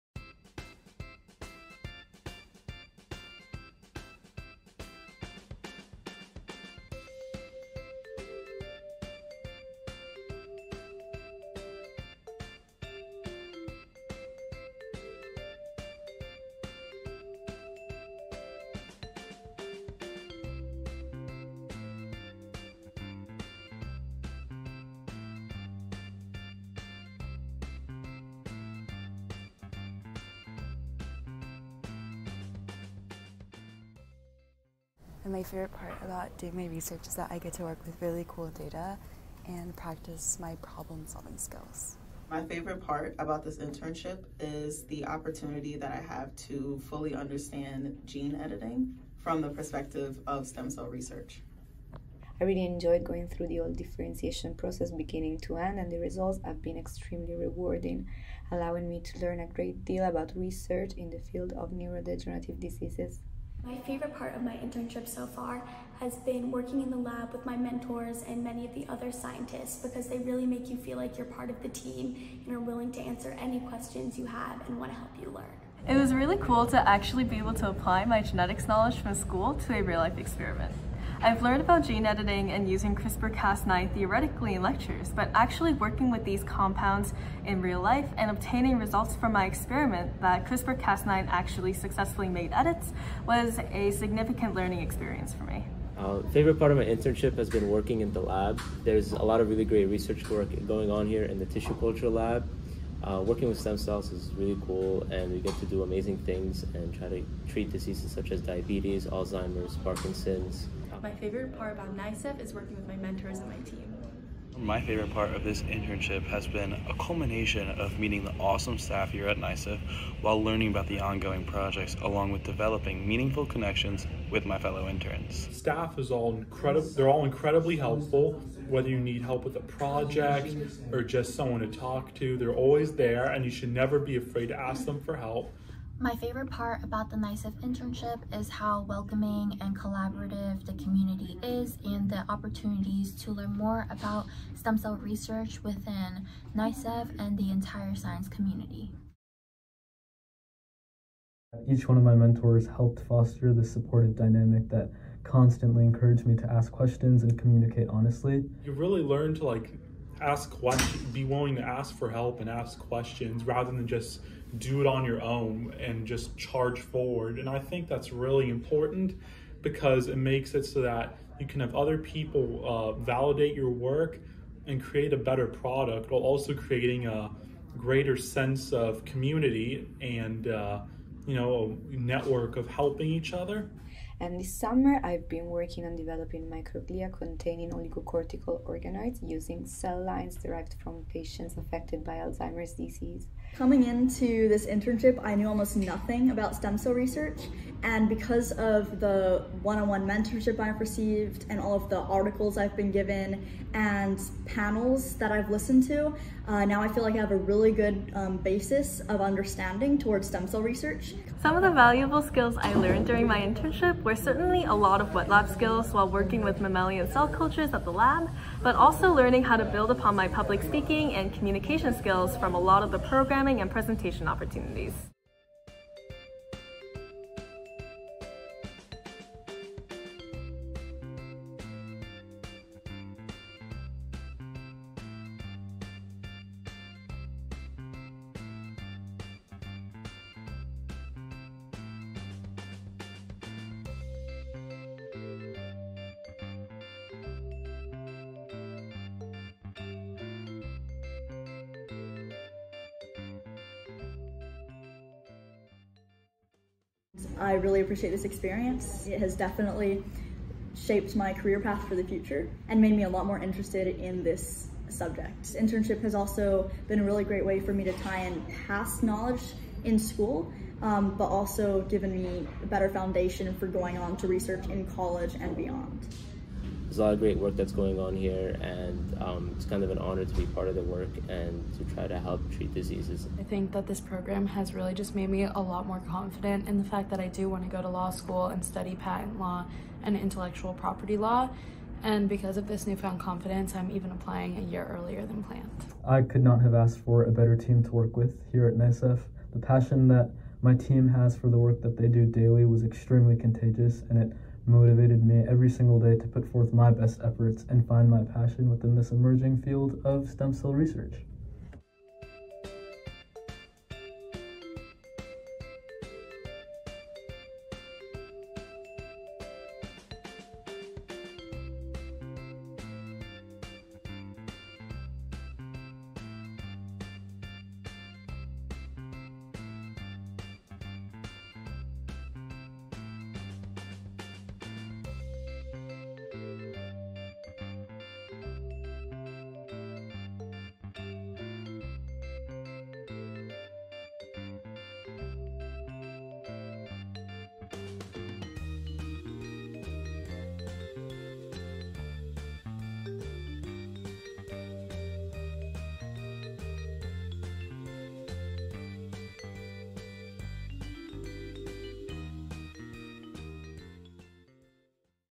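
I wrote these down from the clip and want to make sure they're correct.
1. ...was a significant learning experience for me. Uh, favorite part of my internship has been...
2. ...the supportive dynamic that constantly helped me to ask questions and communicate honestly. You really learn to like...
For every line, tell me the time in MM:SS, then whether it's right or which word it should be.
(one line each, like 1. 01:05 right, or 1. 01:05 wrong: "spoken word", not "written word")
1. 01:33 right
2. 02:33 wrong: "encouraged", not "helped".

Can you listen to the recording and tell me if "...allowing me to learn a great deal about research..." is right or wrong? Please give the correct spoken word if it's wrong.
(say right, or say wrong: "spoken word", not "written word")
right.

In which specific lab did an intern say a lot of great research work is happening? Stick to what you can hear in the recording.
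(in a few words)
tissue culture lab.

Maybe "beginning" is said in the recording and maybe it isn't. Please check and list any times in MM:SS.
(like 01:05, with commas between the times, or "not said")
00:54.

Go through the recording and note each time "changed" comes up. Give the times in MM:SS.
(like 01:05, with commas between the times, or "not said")
not said.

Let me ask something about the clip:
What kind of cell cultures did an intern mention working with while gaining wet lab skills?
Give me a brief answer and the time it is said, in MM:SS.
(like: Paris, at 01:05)
mammalian cell cultures, at 03:36.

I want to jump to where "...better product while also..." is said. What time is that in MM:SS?
02:55.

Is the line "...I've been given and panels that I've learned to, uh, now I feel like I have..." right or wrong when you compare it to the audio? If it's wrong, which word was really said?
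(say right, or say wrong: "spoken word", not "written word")
wrong: "listened", not "learned".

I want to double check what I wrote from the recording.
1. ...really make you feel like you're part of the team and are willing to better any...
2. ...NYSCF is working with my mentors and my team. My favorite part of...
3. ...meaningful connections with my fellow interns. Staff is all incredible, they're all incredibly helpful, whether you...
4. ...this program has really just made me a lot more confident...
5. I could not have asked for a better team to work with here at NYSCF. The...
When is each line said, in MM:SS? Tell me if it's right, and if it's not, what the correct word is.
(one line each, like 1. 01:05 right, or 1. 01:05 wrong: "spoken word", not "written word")
1. 01:10 wrong: "answer", not "better"
2. 01:51 right
3. 02:03 right
4. 04:43 right
5. 04:56 right.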